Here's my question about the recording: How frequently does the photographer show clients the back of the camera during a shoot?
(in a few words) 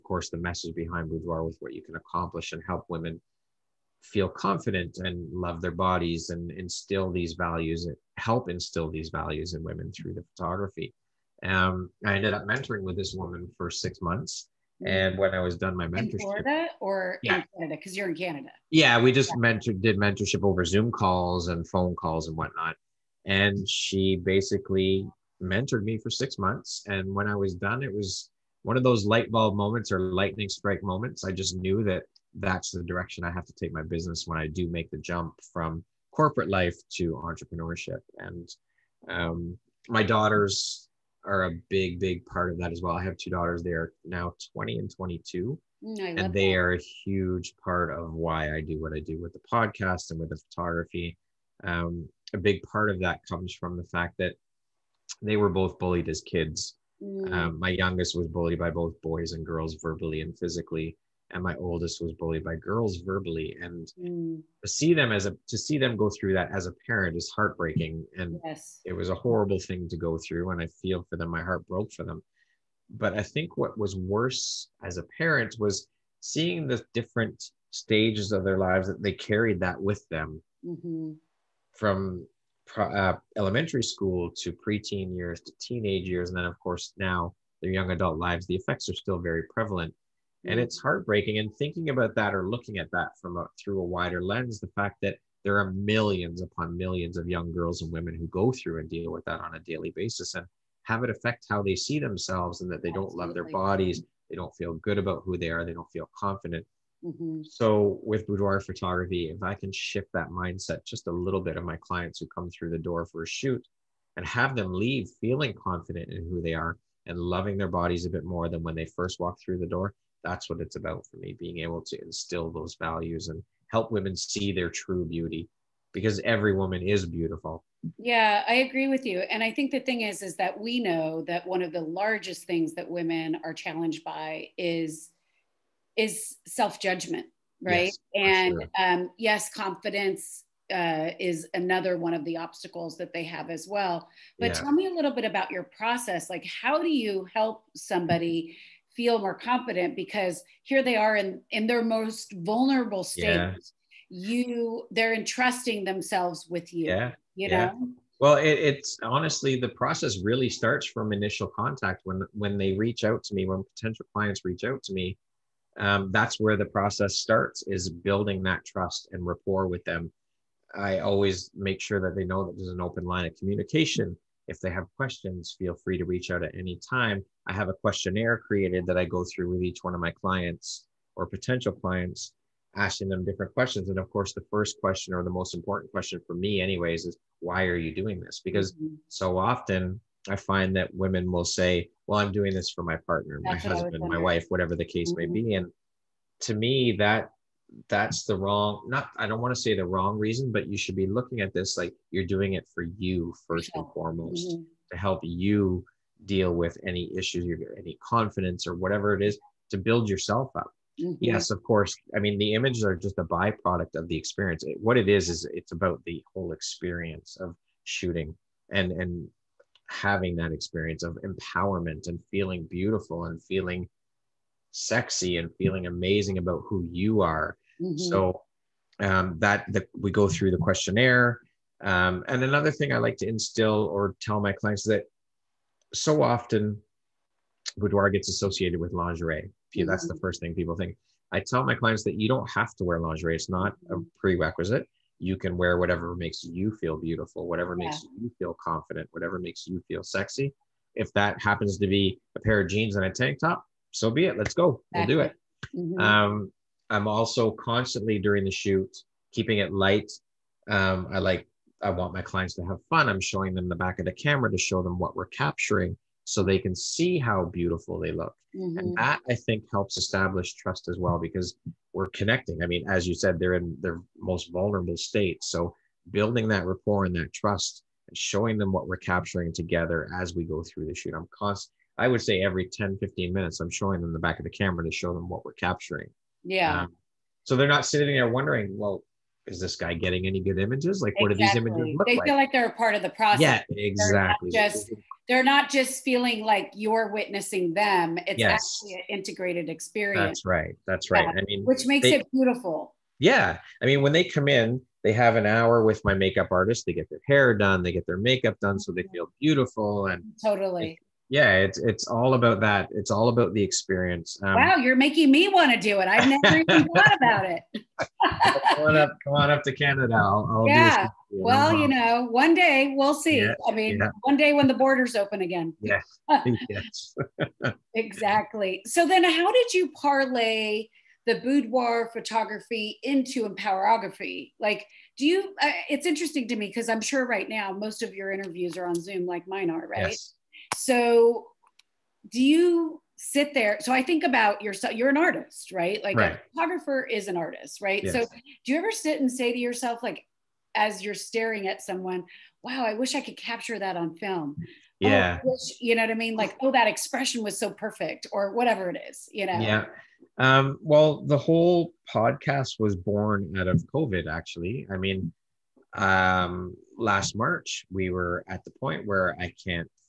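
Every 10-15 minutes.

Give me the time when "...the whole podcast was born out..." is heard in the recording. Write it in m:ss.
6:01.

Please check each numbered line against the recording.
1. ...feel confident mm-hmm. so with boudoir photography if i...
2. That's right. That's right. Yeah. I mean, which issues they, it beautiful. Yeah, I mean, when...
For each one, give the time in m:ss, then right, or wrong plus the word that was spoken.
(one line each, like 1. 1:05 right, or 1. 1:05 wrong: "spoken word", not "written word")
1. 1:45 right
2. 5:00 wrong: "makes", not "issues".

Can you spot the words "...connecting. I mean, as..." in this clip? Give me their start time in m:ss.
4:32.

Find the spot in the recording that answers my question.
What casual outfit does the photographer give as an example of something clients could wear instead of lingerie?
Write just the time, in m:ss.
4:12.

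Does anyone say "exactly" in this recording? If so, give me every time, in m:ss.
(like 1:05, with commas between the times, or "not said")
4:53, 5:27.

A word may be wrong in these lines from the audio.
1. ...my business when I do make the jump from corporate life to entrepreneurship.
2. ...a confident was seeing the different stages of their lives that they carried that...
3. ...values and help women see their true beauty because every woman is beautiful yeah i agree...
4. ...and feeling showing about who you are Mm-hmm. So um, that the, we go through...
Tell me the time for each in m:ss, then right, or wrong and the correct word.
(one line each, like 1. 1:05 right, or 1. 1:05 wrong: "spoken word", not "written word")
1. 0:33 right
2. 1:14 wrong: "parent", not "confident"
3. 2:02 right
4. 3:45 wrong: "amazing", not "showing".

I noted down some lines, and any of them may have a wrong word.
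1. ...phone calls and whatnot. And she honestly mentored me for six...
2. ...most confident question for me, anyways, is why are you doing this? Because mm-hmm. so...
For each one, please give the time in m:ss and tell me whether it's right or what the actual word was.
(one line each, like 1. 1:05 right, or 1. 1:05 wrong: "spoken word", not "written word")
1. 0:21 wrong: "basically", not "honestly"
2. 3:05 wrong: "important", not "confident".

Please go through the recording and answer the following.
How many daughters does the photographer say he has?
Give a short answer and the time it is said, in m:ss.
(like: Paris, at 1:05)
2, at 0:43.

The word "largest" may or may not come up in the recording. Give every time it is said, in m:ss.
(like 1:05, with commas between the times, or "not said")
2:11.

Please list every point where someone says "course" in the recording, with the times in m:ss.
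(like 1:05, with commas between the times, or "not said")
0:00, 1:26, 3:04, 3:31.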